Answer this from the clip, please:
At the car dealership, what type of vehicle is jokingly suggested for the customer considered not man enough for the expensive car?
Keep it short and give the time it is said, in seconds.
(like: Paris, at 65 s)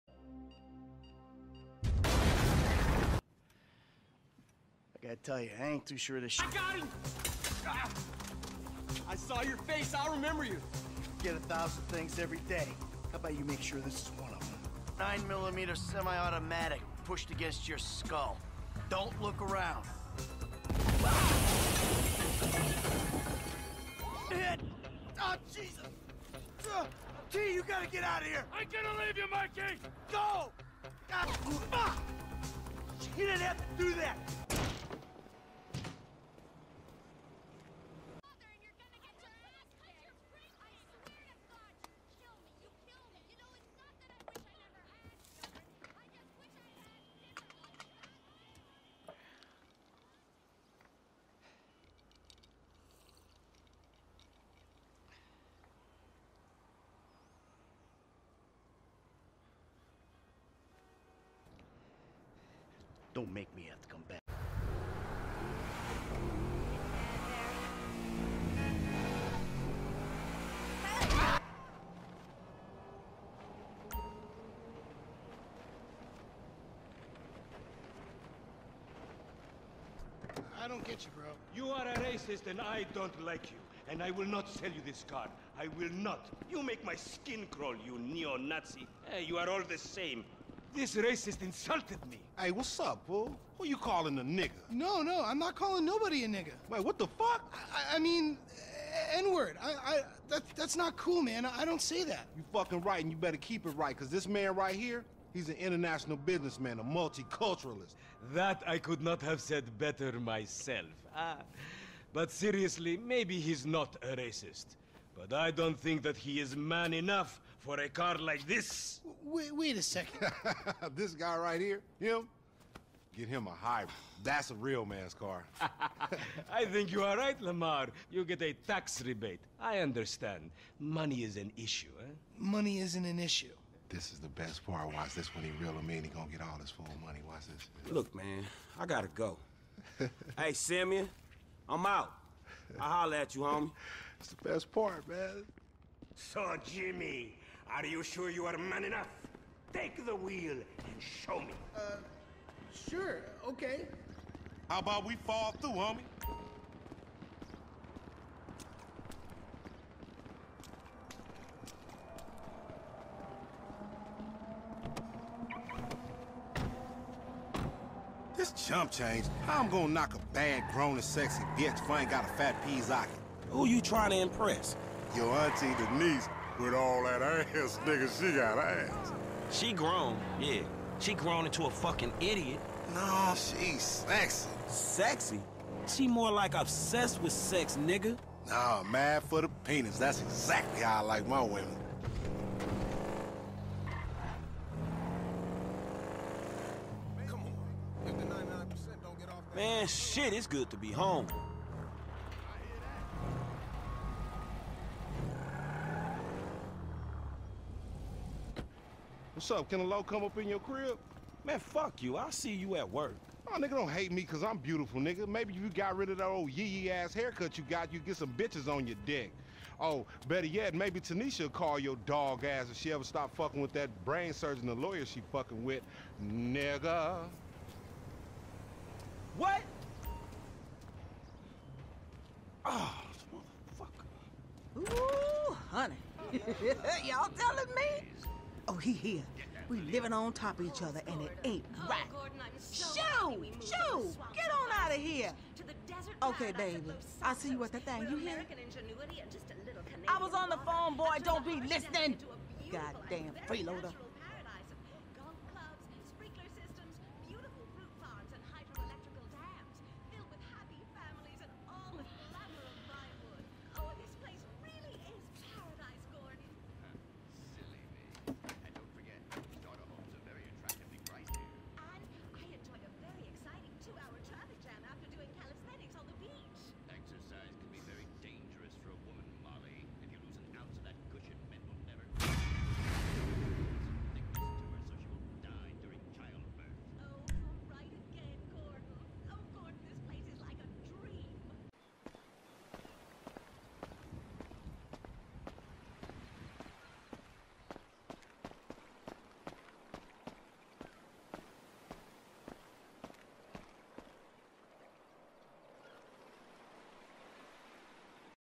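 hybrid, at 123 s.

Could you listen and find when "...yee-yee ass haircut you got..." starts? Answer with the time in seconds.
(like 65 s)
216 s.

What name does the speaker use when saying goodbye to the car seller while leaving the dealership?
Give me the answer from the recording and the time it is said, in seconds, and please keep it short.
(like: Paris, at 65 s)
Simeon, at 140 s.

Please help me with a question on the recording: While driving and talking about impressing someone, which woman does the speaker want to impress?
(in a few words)
Auntie Denise.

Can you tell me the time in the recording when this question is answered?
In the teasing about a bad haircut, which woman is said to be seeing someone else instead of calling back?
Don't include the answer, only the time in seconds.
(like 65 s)
220 s.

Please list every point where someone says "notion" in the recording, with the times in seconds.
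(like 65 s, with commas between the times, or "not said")
not said.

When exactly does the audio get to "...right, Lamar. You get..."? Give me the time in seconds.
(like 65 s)
127 s.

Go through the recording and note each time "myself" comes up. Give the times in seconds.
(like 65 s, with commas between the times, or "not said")
110 s.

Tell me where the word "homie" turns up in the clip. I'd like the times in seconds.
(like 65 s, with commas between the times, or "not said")
143 s, 155 s.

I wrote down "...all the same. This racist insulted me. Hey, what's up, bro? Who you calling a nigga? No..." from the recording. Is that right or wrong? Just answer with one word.
right.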